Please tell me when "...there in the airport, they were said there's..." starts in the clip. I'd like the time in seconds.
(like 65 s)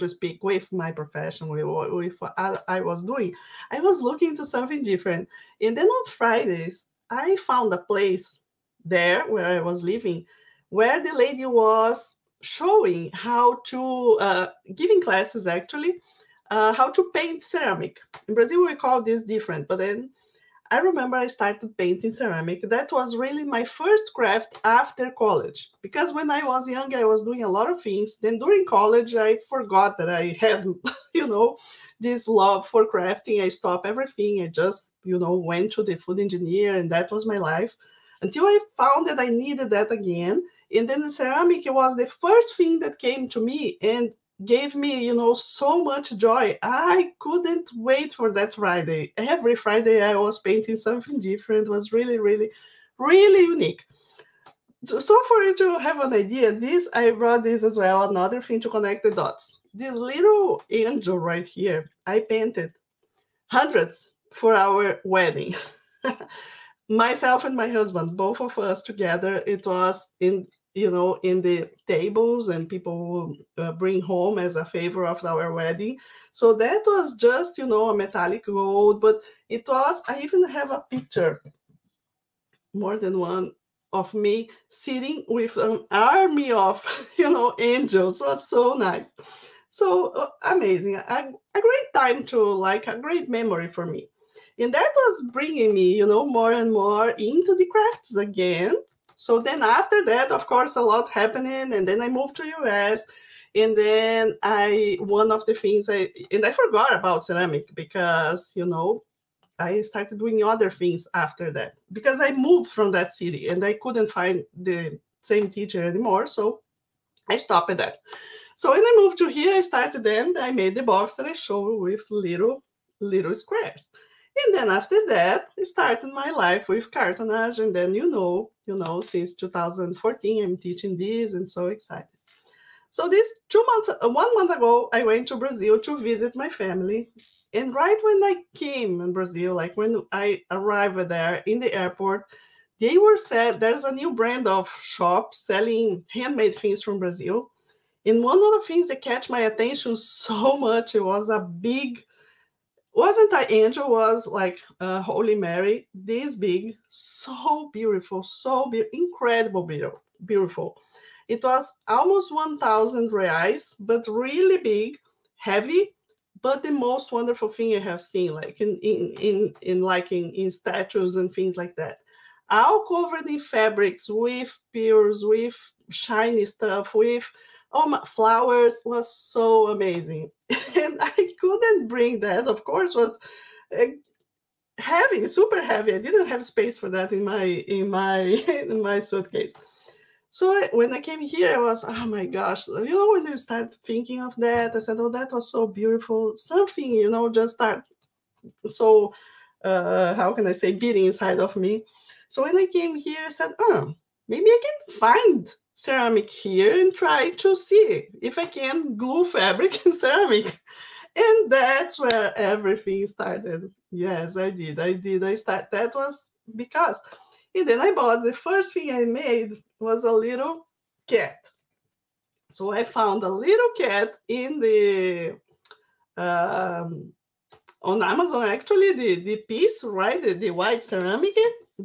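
141 s.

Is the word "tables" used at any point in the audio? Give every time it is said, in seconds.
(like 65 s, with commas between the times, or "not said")
71 s.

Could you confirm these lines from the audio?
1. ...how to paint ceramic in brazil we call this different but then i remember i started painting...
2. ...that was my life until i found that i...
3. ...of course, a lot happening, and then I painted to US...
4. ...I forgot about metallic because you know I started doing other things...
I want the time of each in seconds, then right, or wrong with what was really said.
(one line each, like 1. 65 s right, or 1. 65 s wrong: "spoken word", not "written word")
1. 16 s right
2. 36 s right
3. 100 s wrong: "moved", not "painted"
4. 106 s wrong: "ceramic", not "metallic".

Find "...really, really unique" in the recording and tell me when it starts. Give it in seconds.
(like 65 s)
52 s.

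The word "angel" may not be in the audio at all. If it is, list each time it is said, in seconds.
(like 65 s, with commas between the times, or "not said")
60 s, 87 s, 153 s.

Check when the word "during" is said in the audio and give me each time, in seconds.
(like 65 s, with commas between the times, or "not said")
28 s.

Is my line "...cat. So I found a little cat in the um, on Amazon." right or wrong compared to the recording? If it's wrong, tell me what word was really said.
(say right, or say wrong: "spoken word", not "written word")
right.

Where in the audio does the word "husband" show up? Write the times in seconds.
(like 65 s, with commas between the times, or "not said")
67 s.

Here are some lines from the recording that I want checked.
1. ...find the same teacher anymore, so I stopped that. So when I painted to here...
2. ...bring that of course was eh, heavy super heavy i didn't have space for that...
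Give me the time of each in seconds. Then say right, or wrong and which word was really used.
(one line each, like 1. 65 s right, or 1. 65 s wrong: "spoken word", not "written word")
1. 114 s wrong: "moved", not "painted"
2. 181 s right.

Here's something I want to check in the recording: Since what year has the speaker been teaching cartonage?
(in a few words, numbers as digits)
2014.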